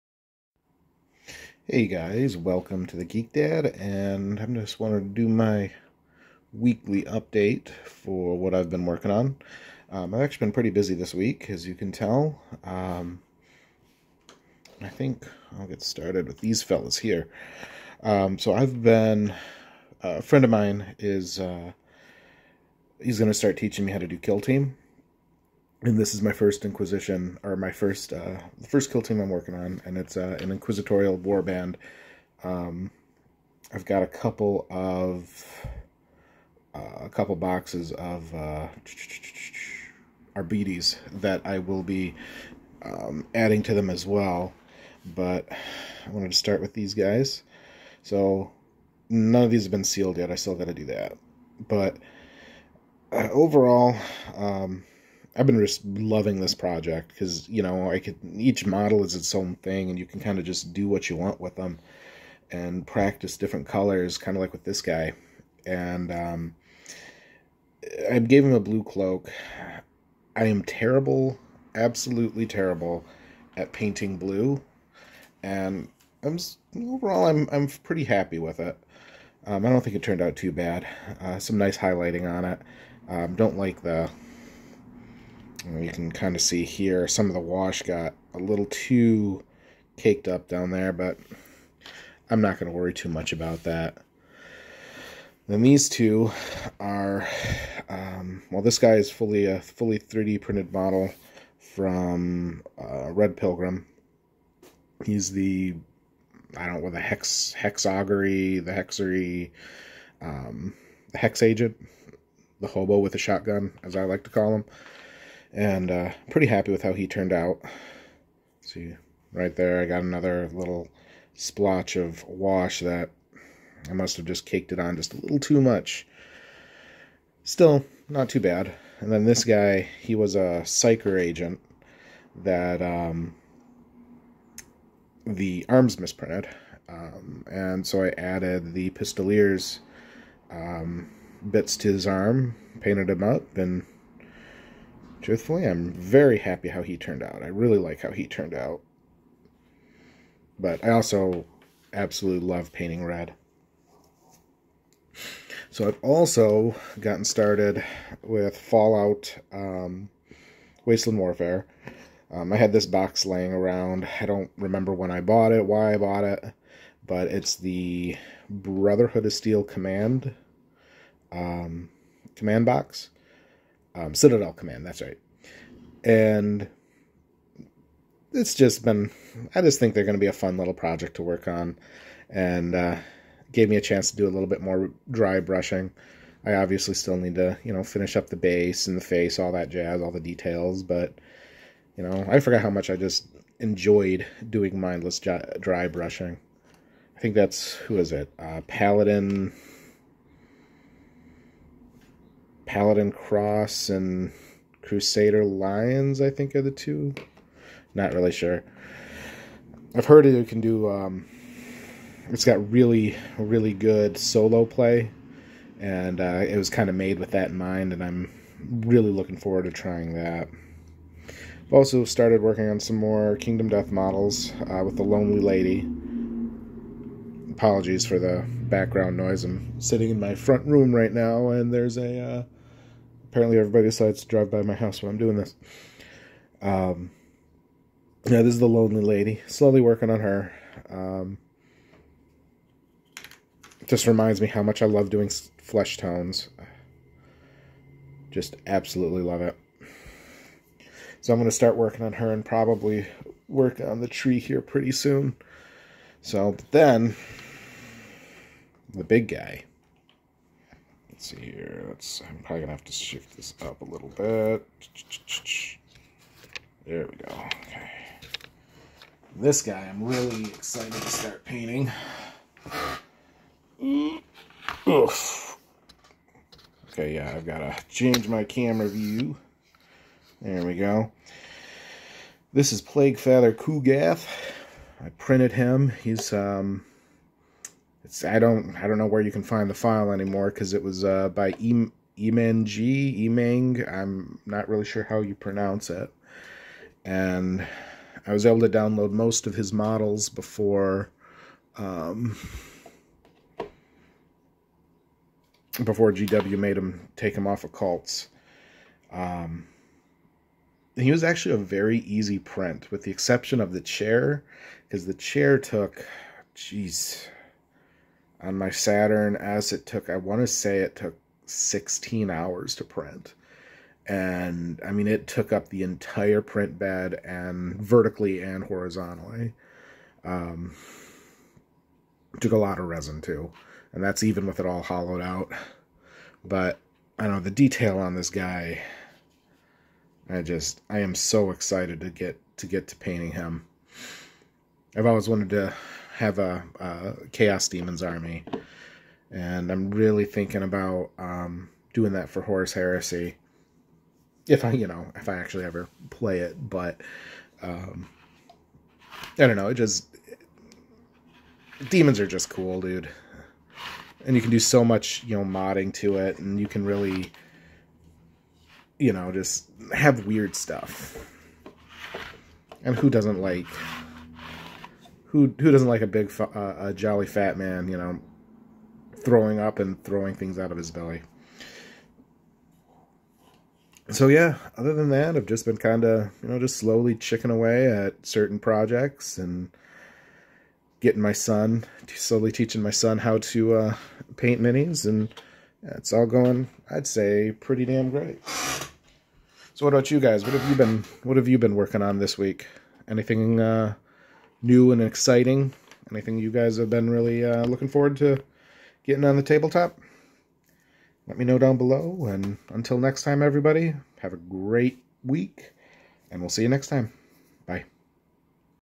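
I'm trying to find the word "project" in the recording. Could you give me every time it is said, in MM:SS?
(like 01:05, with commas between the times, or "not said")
00:56, 03:00, 06:28.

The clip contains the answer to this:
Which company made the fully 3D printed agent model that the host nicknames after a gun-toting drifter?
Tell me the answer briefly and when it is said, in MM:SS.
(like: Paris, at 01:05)
Red Pilgrim, at 01:43.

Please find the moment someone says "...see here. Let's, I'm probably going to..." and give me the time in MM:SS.
04:21.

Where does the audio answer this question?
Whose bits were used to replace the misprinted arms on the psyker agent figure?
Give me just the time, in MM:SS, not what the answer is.
02:18.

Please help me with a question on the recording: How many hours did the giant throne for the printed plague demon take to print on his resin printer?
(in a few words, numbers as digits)
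16.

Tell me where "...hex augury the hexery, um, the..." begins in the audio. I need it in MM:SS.
01:46.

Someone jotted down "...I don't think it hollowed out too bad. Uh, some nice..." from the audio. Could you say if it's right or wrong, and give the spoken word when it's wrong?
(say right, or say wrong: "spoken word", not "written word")
wrong: "turned", not "hollowed".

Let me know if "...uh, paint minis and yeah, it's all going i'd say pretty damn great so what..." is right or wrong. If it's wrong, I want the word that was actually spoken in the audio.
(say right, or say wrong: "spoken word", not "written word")
right.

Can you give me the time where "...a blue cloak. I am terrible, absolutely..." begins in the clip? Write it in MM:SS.
01:08.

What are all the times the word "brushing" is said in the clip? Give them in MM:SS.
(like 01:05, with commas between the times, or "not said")
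03:05, 03:15.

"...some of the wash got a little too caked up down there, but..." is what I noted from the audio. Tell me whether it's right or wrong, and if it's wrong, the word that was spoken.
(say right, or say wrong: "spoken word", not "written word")
right.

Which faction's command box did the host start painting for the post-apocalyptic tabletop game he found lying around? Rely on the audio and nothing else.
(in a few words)
Brotherhood of Steel.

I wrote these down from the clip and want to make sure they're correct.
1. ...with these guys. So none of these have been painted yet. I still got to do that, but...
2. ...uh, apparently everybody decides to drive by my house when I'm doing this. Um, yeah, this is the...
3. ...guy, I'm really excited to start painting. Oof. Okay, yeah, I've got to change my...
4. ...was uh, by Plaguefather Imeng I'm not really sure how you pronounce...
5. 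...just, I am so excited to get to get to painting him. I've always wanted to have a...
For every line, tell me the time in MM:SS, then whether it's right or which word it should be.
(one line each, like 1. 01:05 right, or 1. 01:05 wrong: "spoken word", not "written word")
1. 00:46 wrong: "sealed", not "painted"
2. 03:52 right
3. 04:29 right
4. 04:50 wrong: "Emang", not "Plaguefather"
5. 05:40 right.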